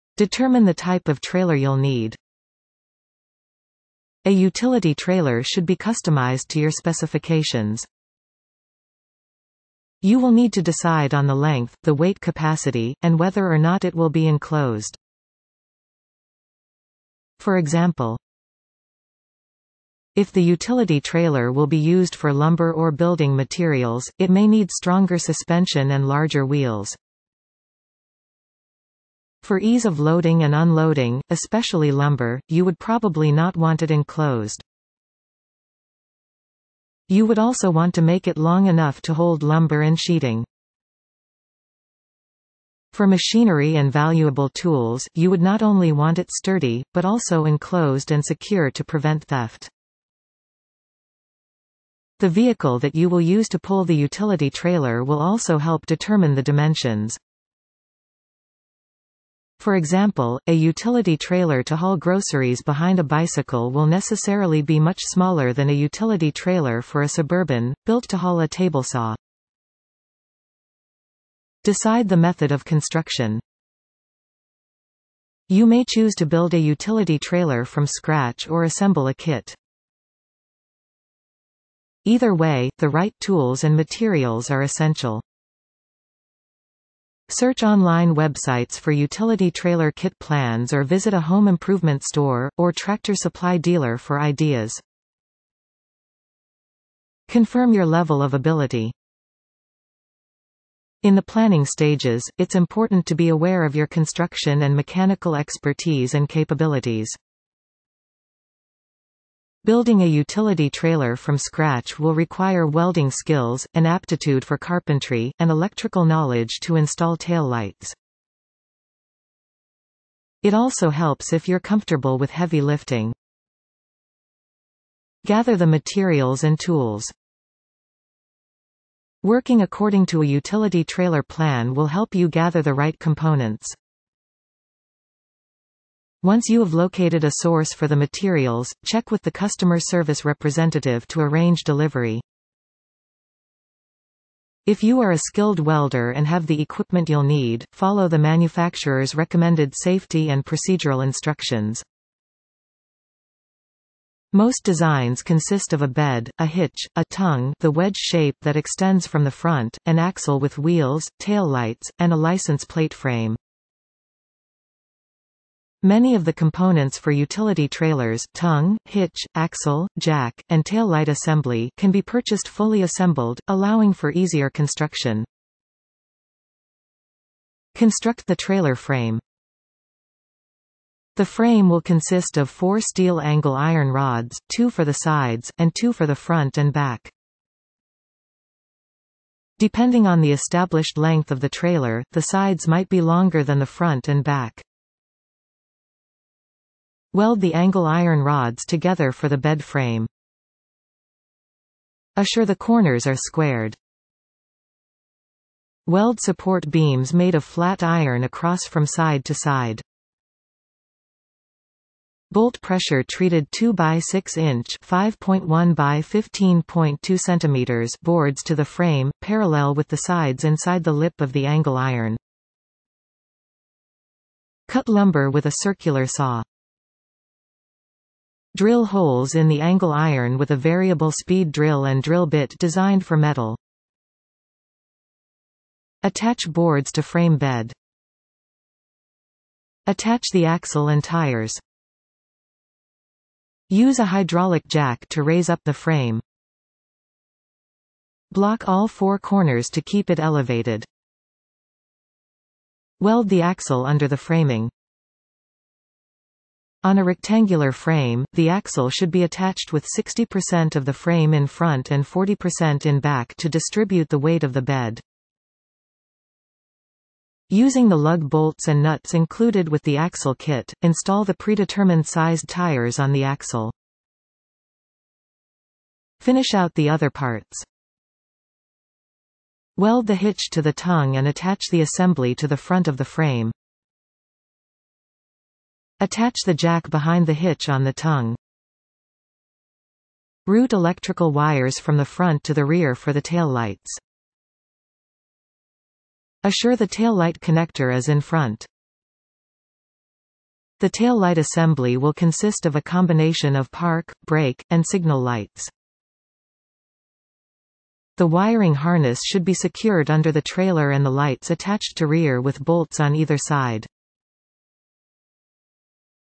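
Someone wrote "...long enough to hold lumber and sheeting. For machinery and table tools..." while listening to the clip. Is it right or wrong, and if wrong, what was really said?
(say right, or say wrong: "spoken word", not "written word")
wrong: "valuable", not "table".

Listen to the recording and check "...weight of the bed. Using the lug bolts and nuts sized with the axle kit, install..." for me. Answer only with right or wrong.
wrong.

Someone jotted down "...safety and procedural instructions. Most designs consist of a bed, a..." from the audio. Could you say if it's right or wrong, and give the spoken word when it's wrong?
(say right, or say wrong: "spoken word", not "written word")
right.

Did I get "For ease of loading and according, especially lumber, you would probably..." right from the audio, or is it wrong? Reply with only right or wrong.
wrong.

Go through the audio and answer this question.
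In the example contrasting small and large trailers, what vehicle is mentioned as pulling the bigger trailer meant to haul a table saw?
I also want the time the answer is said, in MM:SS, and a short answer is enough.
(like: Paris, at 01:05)
Suburban, at 01:07.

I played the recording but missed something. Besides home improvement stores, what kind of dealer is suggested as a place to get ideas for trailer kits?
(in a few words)
tractor supply dealer.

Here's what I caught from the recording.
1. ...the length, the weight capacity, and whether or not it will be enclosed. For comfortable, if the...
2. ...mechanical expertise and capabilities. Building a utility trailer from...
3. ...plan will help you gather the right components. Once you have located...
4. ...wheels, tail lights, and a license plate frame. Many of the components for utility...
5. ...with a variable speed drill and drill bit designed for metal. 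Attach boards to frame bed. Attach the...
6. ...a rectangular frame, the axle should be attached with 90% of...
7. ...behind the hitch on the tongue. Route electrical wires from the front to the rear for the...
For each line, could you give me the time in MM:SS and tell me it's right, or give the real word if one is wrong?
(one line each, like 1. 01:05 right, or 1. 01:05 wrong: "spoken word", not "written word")
1. 00:11 wrong: "example", not "comfortable"
2. 01:44 right
3. 02:11 right
4. 02:40 right
5. 03:50 right
6. 04:16 wrong: "60", not "90"
7. 04:46 right.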